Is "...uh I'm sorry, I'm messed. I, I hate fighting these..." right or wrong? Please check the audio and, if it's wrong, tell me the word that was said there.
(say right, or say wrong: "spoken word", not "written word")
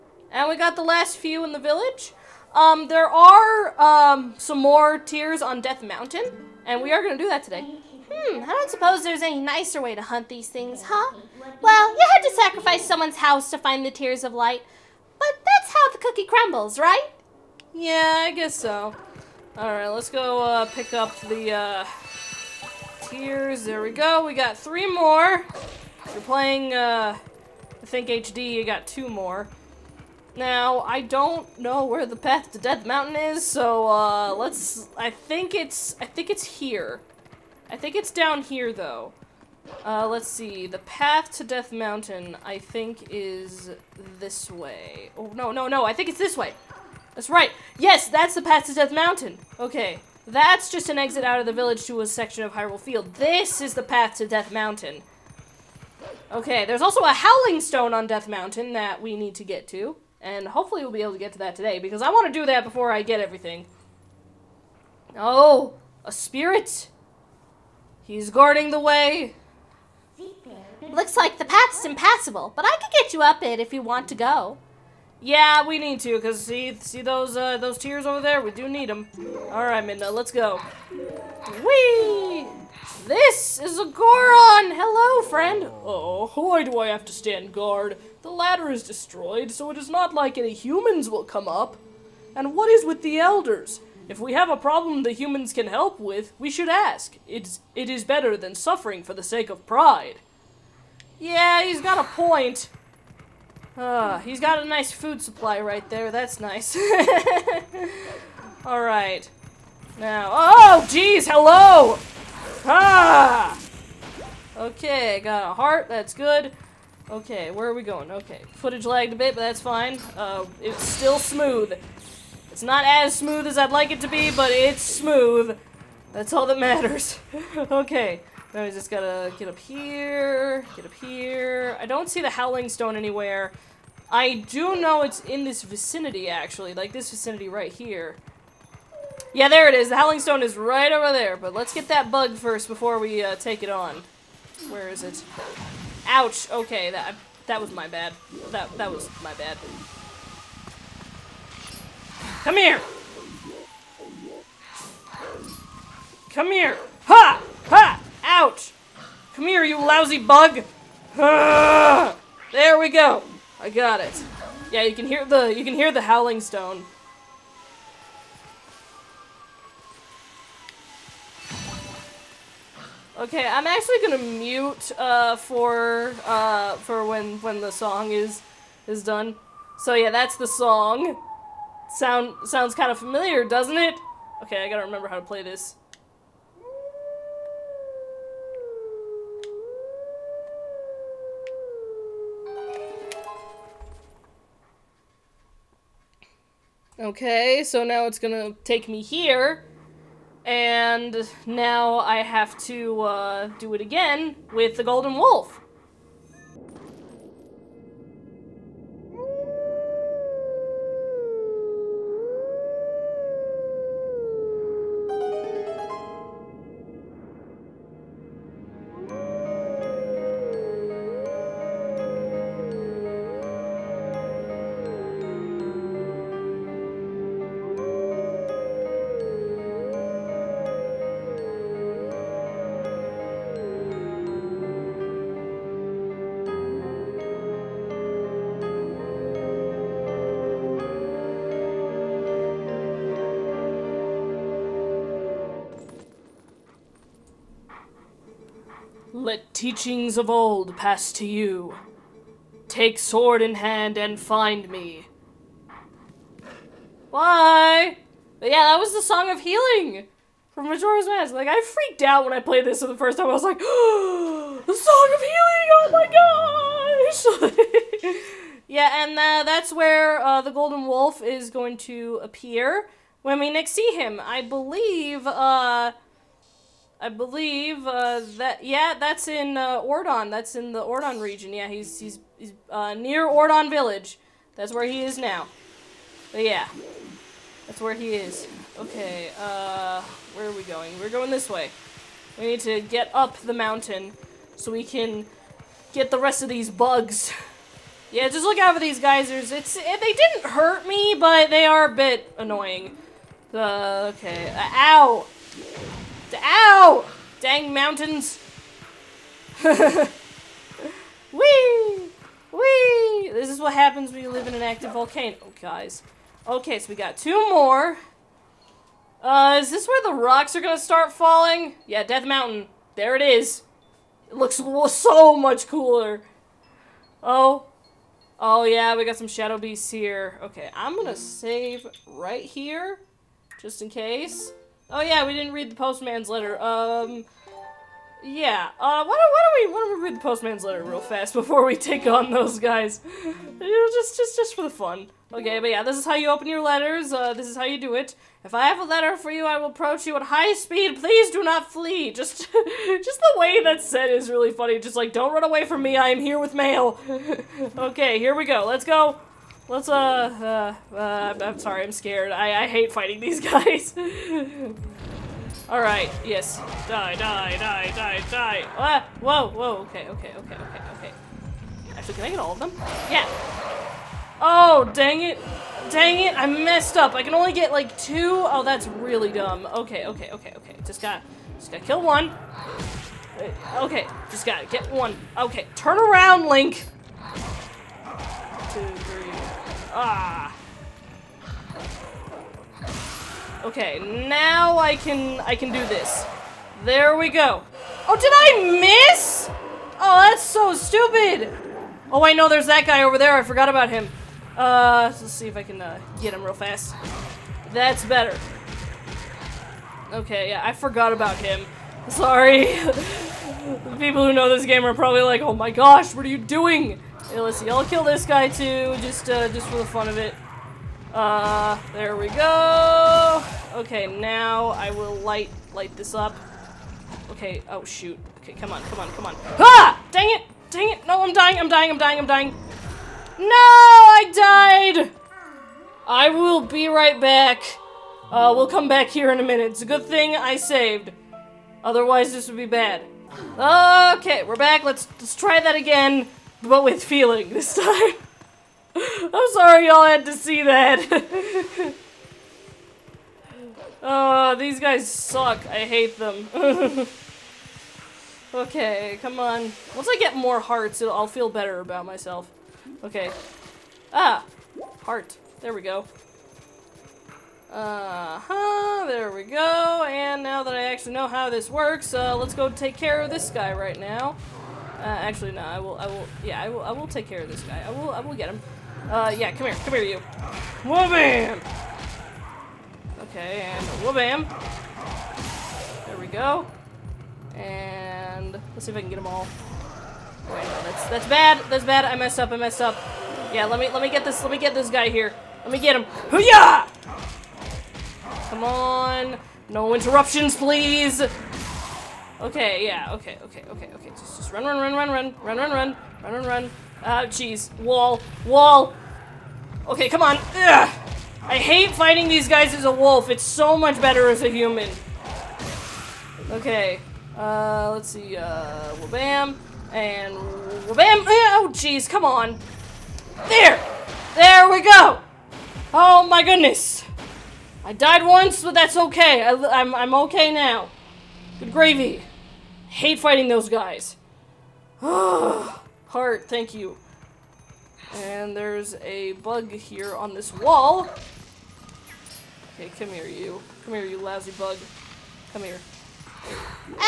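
wrong: "scared", not "messed".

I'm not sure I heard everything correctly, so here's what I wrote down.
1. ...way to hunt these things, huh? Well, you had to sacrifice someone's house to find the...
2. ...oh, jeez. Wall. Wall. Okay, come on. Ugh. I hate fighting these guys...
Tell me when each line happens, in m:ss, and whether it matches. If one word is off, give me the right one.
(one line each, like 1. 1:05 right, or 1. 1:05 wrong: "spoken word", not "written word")
1. 0:09 right
2. 8:27 right.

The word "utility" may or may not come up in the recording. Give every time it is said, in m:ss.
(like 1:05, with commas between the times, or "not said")
not said.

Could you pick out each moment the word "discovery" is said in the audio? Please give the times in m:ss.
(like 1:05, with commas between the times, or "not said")
not said.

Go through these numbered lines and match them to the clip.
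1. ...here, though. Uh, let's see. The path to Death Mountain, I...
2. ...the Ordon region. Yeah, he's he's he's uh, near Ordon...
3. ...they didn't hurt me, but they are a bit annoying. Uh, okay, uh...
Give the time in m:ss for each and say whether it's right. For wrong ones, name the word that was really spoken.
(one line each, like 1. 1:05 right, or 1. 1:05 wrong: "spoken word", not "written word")
1. 0:38 right
2. 4:40 right
3. 5:00 right.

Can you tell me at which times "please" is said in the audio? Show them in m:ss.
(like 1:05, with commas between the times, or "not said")
5:51, 8:20.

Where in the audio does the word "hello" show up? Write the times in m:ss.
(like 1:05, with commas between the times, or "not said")
1:24, 1:51.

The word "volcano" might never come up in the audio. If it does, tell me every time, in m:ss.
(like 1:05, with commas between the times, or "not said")
5:14.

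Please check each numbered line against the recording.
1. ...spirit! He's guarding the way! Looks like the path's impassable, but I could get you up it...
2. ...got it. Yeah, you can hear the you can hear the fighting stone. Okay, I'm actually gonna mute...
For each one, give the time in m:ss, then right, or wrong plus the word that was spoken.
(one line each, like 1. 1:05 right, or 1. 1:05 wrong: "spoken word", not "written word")
1. 1:06 right
2. 2:43 wrong: "howling", not "fighting".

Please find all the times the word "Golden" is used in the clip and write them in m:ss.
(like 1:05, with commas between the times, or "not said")
3:24, 4:30.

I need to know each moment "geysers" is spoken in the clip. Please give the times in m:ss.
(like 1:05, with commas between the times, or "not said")
4:58.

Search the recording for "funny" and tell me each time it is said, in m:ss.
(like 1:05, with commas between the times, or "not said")
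5:54.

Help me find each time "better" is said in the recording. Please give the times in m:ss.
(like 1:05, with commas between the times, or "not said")
1:38, 6:48, 7:41, 8:34.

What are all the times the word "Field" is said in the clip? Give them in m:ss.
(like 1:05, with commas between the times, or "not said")
0:52.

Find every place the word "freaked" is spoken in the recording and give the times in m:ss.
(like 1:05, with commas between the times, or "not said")
4:21.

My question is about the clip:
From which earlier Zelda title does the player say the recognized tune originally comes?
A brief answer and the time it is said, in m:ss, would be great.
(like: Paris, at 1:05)
Majora's Mask, at 4:20.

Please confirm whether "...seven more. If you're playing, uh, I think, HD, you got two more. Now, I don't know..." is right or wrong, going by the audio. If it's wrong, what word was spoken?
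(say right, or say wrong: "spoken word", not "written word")
wrong: "three", not "seven".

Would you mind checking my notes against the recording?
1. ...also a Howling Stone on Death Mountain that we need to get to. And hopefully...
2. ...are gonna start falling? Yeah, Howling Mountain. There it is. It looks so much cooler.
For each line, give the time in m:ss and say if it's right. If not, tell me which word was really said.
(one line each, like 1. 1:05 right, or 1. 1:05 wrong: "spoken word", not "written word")
1. 0:56 right
2. 5:20 wrong: "Death", not "Howling".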